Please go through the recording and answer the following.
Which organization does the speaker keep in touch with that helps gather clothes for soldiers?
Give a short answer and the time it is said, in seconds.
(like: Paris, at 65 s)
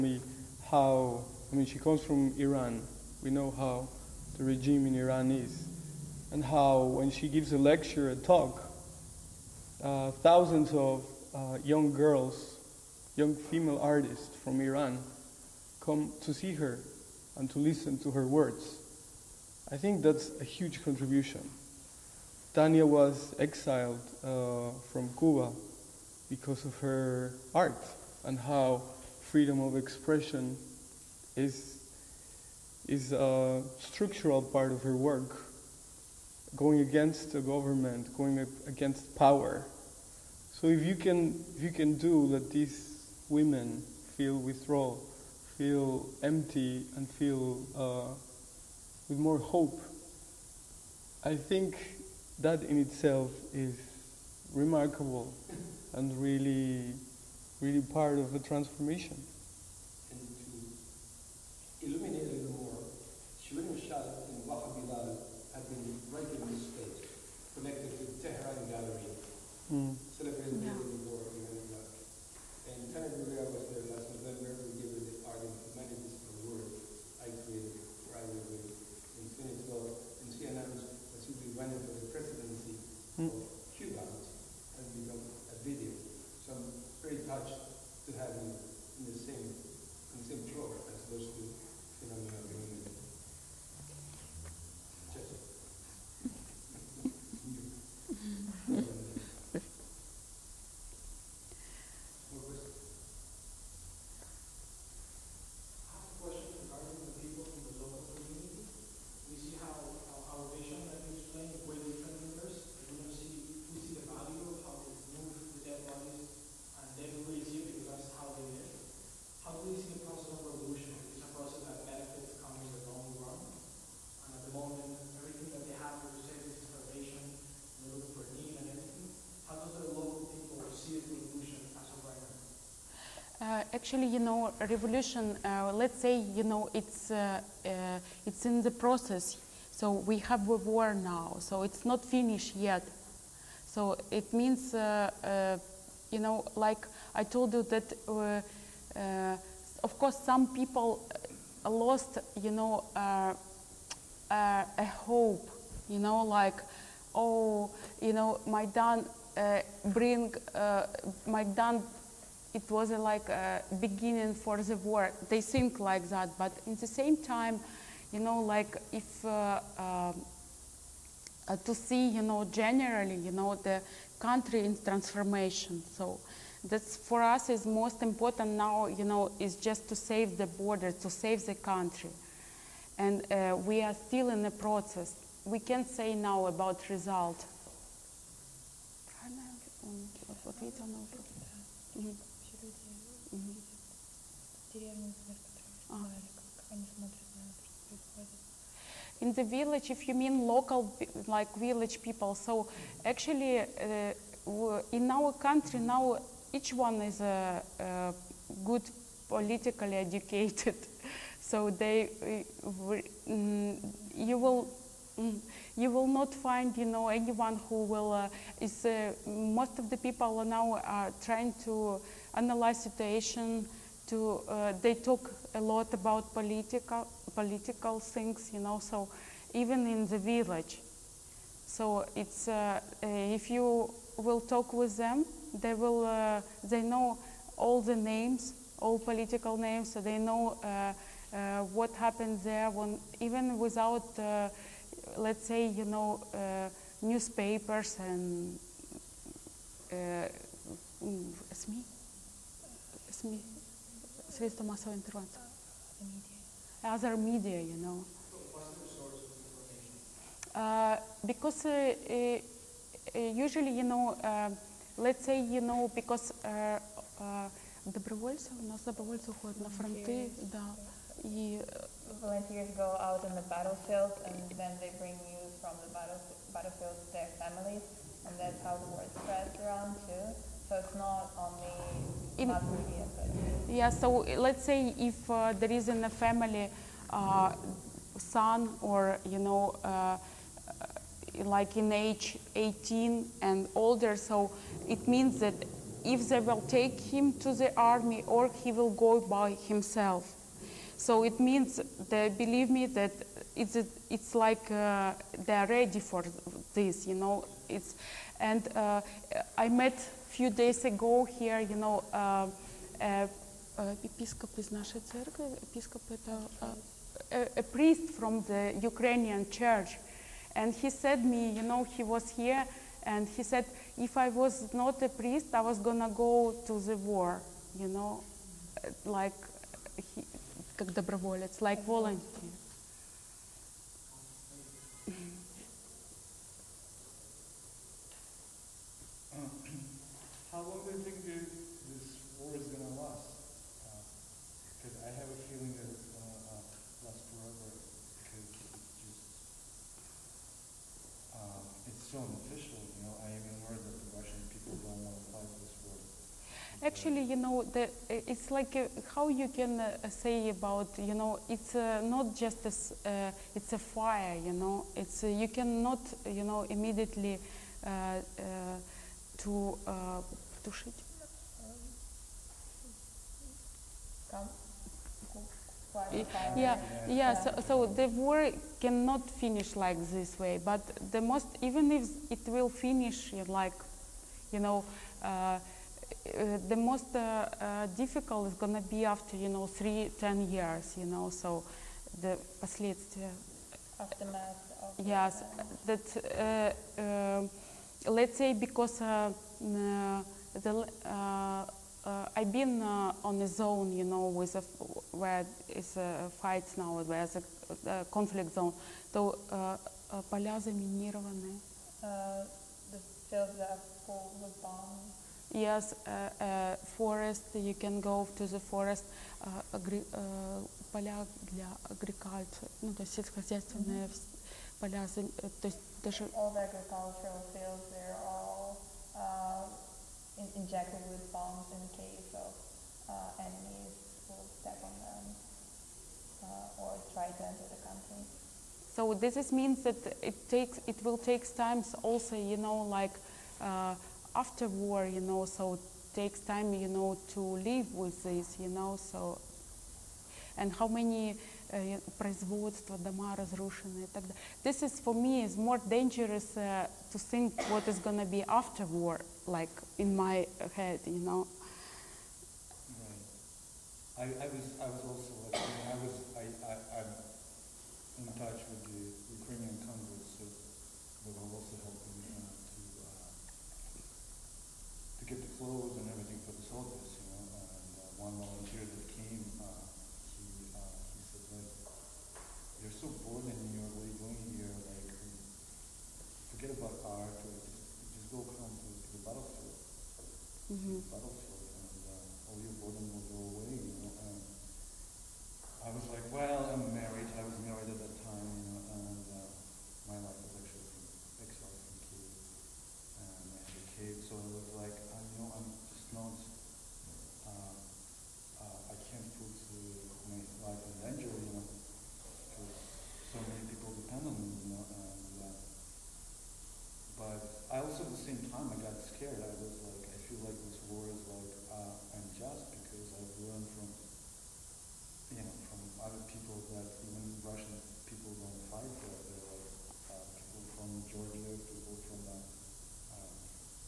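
Ukrainian Congress, at 469 s.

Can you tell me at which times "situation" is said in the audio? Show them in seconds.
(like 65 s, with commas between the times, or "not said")
222 s.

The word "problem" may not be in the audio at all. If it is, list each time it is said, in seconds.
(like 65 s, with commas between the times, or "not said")
not said.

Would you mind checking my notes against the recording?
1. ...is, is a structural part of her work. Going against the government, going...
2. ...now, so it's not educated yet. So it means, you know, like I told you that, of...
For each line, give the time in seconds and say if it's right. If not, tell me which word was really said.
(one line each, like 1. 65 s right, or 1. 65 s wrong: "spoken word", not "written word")
1. 31 s right
2. 140 s wrong: "finished", not "educated".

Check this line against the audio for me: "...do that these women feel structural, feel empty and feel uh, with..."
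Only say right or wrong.
wrong.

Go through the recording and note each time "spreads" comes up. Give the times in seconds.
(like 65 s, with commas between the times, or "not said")
279 s.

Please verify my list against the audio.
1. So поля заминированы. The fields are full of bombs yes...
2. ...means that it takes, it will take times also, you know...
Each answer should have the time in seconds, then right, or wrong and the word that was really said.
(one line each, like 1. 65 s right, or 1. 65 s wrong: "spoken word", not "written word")
1. 409 s right
2. 439 s right.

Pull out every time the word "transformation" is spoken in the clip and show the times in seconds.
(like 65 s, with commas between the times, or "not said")
58 s, 174 s.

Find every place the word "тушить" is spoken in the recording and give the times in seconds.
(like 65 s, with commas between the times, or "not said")
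370 s.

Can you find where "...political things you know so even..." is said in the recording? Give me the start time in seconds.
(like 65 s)
227 s.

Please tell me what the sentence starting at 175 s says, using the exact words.
So that's for us is most important now, you know, is just to save the border, to save the country.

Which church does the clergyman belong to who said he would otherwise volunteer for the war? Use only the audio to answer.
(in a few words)
Ukrainian church.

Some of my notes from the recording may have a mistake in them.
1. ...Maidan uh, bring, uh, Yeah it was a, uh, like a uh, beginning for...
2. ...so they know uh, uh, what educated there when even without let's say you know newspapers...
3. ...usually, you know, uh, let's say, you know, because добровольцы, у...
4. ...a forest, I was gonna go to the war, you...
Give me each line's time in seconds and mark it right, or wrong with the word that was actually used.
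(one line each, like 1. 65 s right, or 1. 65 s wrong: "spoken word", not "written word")
1. 158 s wrong: "Maidan", not "Yeah"
2. 239 s wrong: "happened", not "educated"
3. 263 s right
4. 325 s wrong: "priest", not "forest".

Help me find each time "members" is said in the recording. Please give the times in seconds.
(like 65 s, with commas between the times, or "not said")
not said.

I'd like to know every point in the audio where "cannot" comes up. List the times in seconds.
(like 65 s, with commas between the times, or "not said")
365 s, 378 s.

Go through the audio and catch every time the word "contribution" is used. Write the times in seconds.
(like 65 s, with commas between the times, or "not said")
20 s.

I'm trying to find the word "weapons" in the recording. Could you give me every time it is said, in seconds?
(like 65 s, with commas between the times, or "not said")
not said.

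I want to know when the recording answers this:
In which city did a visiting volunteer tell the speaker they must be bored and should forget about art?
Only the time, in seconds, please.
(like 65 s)
483 s.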